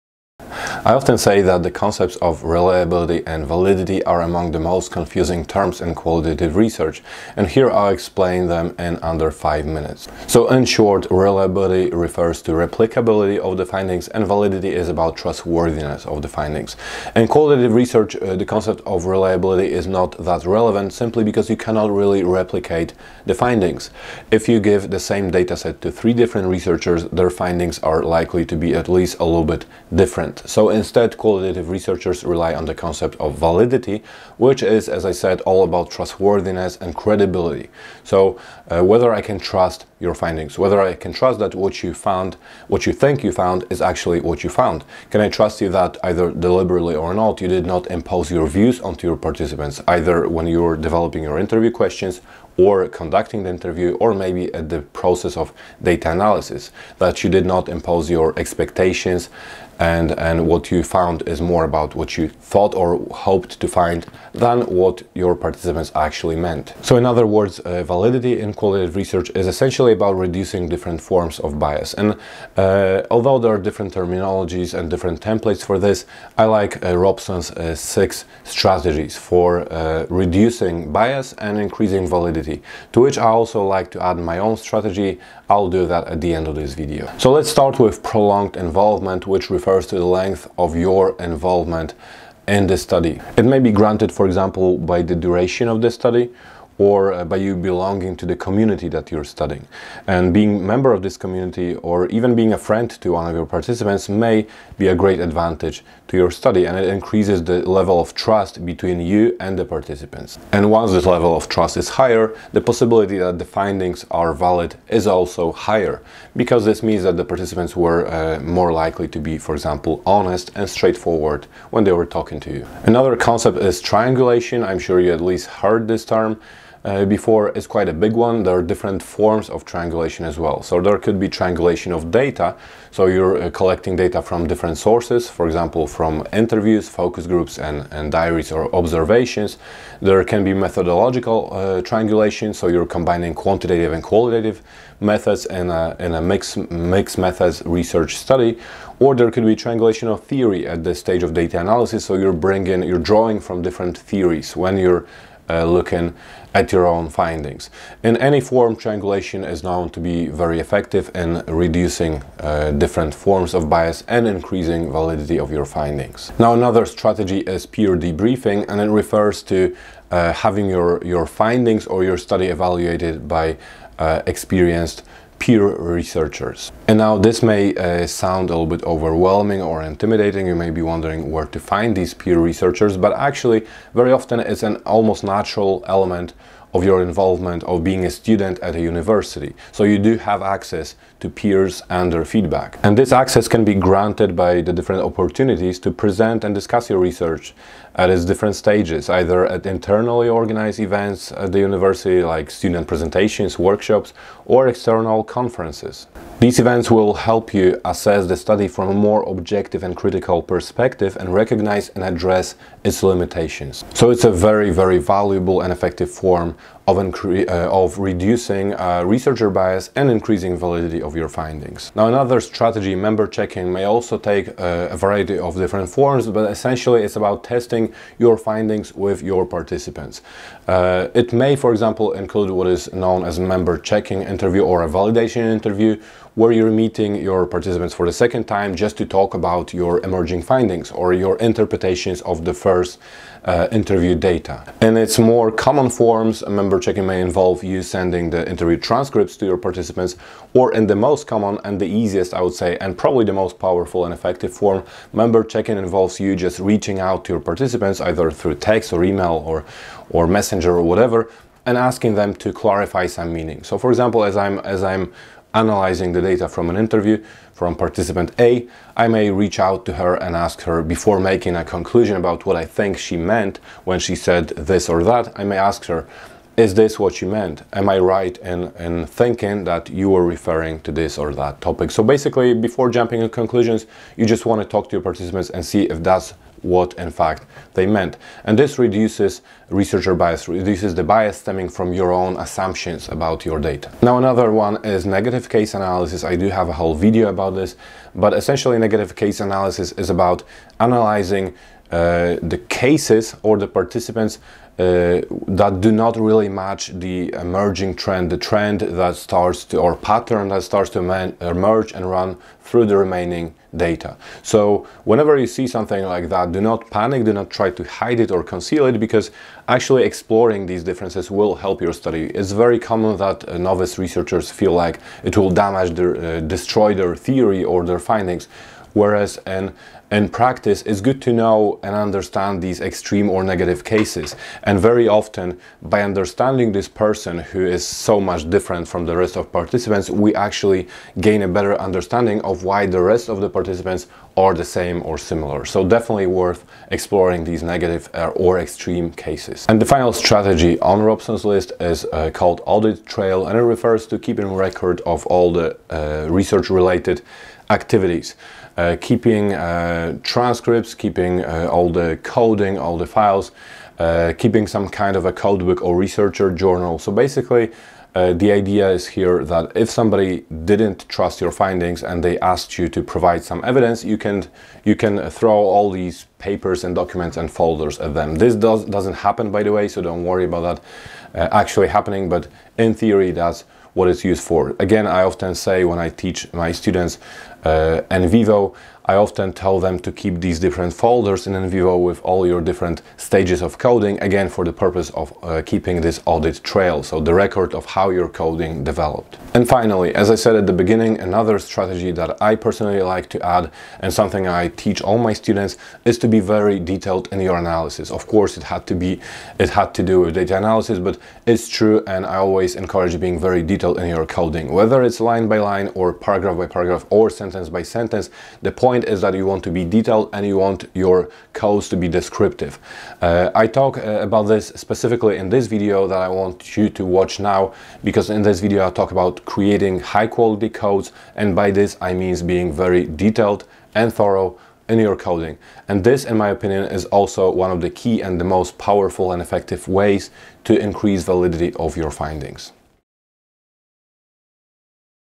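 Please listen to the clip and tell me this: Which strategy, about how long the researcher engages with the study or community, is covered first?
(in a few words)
Prolonged involvement.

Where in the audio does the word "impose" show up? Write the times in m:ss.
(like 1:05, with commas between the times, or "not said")
0:47, 0:57.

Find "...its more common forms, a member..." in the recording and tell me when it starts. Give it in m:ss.
4:04.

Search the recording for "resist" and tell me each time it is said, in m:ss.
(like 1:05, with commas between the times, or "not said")
not said.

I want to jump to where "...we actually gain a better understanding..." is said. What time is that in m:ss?
5:40.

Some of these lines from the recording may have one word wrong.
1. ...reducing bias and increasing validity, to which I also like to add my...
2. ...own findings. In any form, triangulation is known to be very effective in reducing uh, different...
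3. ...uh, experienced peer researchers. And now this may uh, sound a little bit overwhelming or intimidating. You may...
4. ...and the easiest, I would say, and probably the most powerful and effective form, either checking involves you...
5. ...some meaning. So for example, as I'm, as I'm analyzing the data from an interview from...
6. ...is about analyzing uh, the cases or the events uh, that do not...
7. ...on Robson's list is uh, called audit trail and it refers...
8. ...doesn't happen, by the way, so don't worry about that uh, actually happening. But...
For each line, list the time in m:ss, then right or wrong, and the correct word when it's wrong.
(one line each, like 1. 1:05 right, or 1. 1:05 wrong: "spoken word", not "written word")
1. 1:20 right
2. 2:36 right
3. 2:53 right
4. 4:11 wrong: "member", not "either"
5. 4:23 right
6. 4:59 wrong: "participants", not "events"
7. 5:50 right
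8. 6:18 right.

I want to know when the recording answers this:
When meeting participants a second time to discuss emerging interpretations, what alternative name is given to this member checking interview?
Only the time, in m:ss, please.
3:54.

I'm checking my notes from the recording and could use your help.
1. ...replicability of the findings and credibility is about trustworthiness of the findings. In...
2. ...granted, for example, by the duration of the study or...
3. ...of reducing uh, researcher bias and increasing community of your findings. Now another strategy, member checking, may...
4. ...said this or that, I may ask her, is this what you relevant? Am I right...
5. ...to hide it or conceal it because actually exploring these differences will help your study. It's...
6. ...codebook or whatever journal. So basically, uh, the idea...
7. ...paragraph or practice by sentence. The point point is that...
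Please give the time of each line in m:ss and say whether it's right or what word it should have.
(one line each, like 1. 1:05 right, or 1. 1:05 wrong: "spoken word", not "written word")
1. 0:12 wrong: "validity", not "credibility"
2. 1:33 right
3. 3:37 wrong: "validity", not "community"
4. 4:34 wrong: "meant", not "relevant"
5. 5:17 right
6. 6:05 wrong: "researcher", not "whatever"
7. 6:56 wrong: "sentence", not "practice".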